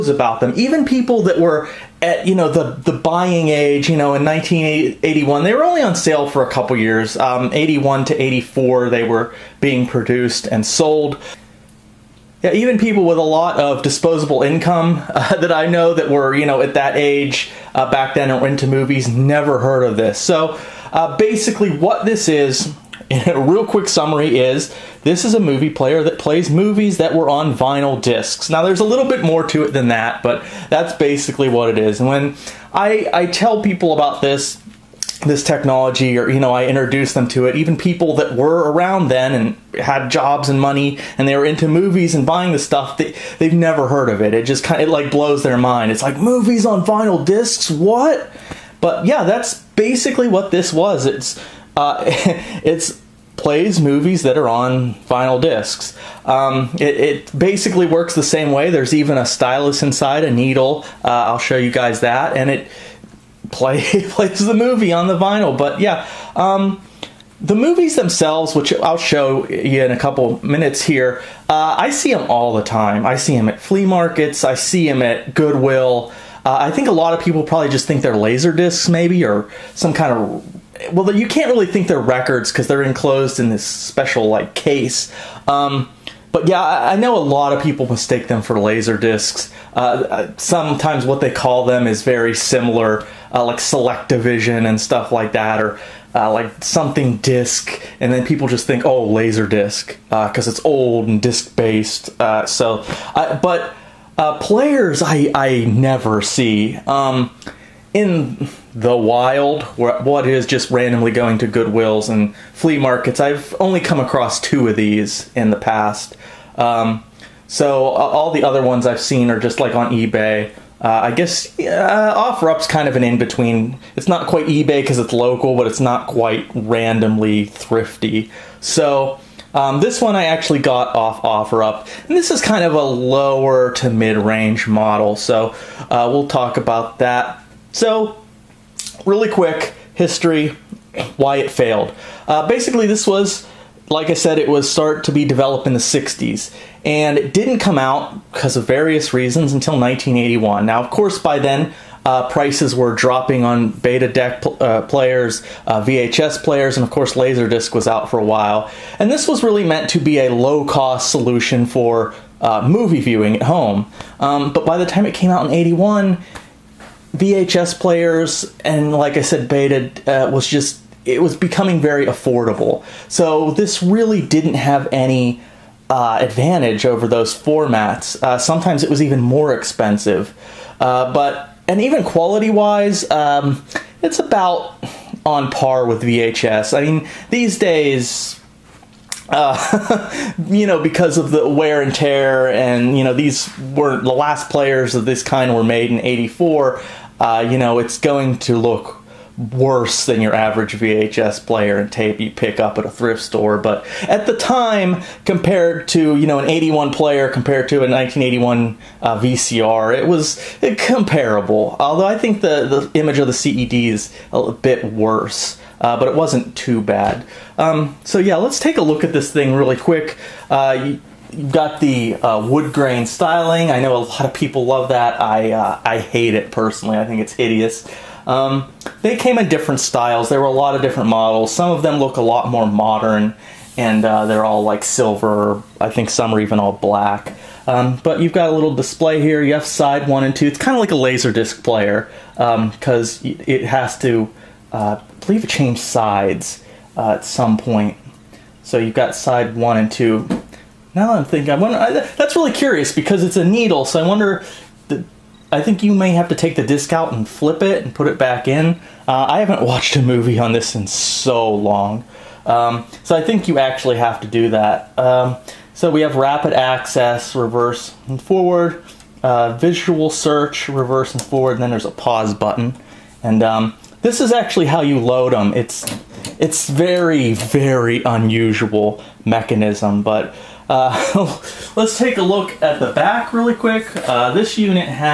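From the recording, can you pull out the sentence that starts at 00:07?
Um, 81 to 84, they were being produced and sold.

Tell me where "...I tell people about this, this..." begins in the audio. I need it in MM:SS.
00:33.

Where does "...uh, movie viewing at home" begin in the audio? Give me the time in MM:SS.
02:42.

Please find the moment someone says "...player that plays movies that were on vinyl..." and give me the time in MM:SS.
00:25.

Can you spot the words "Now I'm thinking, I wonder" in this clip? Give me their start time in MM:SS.
04:10.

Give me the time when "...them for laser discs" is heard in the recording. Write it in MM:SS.
01:28.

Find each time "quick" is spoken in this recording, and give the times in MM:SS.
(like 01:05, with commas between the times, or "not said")
00:23, 02:19, 03:39, 04:43.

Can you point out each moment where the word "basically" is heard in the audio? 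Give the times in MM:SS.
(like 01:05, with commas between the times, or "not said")
00:21, 00:30, 00:49, 00:57, 02:22.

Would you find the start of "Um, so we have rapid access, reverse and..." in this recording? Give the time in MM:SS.
04:24.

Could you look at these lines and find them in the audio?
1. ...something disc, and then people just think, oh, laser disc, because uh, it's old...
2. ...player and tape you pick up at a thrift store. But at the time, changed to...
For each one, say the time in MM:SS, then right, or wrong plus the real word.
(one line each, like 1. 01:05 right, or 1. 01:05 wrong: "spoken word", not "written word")
1. 01:36 right
2. 03:21 wrong: "compared", not "changed".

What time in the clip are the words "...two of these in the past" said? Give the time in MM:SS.
01:54.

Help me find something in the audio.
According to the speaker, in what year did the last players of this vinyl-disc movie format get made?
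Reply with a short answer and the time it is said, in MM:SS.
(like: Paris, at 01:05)
1984, at 03:16.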